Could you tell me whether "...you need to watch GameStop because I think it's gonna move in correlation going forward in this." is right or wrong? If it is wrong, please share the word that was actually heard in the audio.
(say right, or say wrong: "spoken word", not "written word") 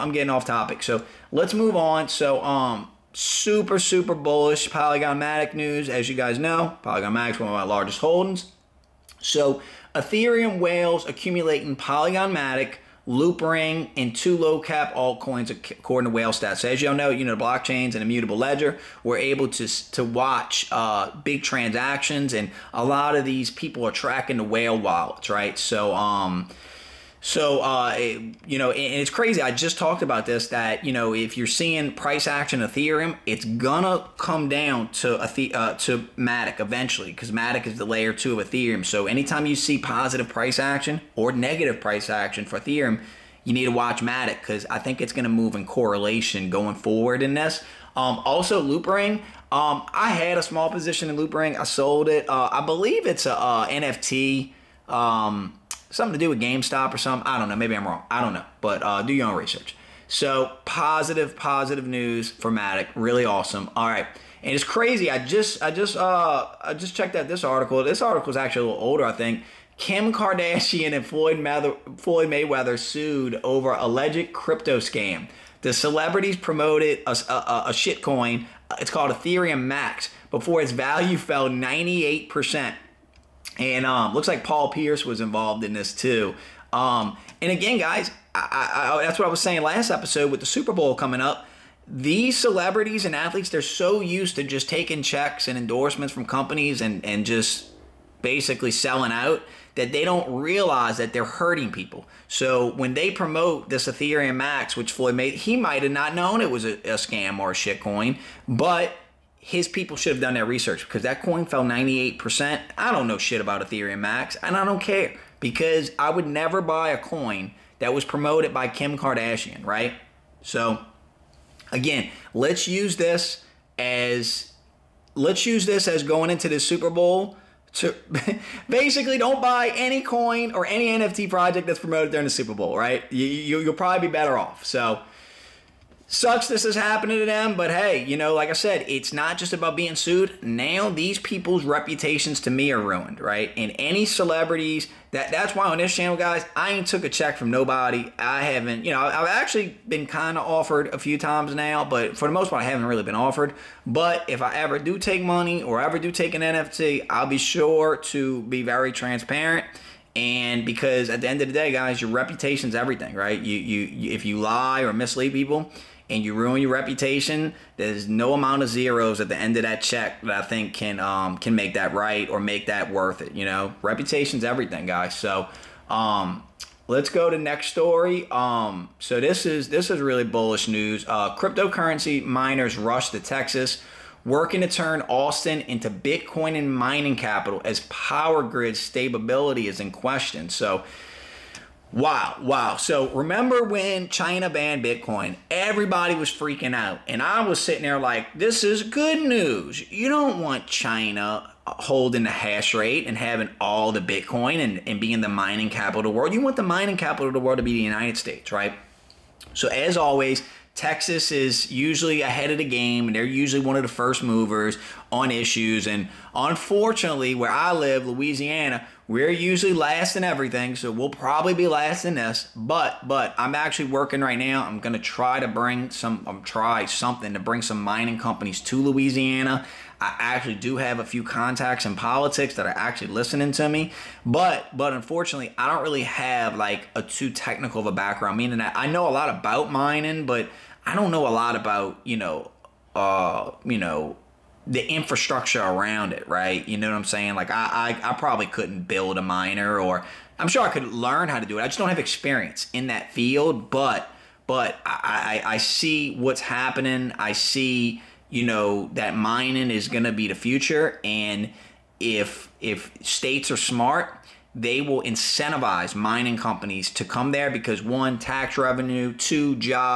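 wrong: "Matic", not "GameStop".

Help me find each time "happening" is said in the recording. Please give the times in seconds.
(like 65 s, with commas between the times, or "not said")
136 s, 256 s.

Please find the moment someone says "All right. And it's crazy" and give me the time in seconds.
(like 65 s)
63 s.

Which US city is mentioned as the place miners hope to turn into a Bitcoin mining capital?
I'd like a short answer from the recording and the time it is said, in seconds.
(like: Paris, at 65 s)
Austin, at 185 s.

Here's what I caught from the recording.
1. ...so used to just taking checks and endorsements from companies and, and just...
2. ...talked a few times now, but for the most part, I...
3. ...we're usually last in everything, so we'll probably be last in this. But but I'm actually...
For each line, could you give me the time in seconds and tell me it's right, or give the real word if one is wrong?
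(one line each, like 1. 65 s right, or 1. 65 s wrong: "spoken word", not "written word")
1. 93 s right
2. 150 s wrong: "offered", not "talked"
3. 219 s right.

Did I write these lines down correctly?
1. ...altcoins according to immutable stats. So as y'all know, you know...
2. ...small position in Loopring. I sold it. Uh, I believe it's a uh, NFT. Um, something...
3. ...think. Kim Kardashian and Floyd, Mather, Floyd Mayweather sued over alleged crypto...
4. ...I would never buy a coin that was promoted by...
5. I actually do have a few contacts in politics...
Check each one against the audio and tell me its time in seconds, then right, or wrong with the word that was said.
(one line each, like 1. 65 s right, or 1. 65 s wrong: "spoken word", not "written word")
1. 14 s wrong: "whale", not "immutable"
2. 50 s right
3. 69 s right
4. 115 s right
5. 229 s right.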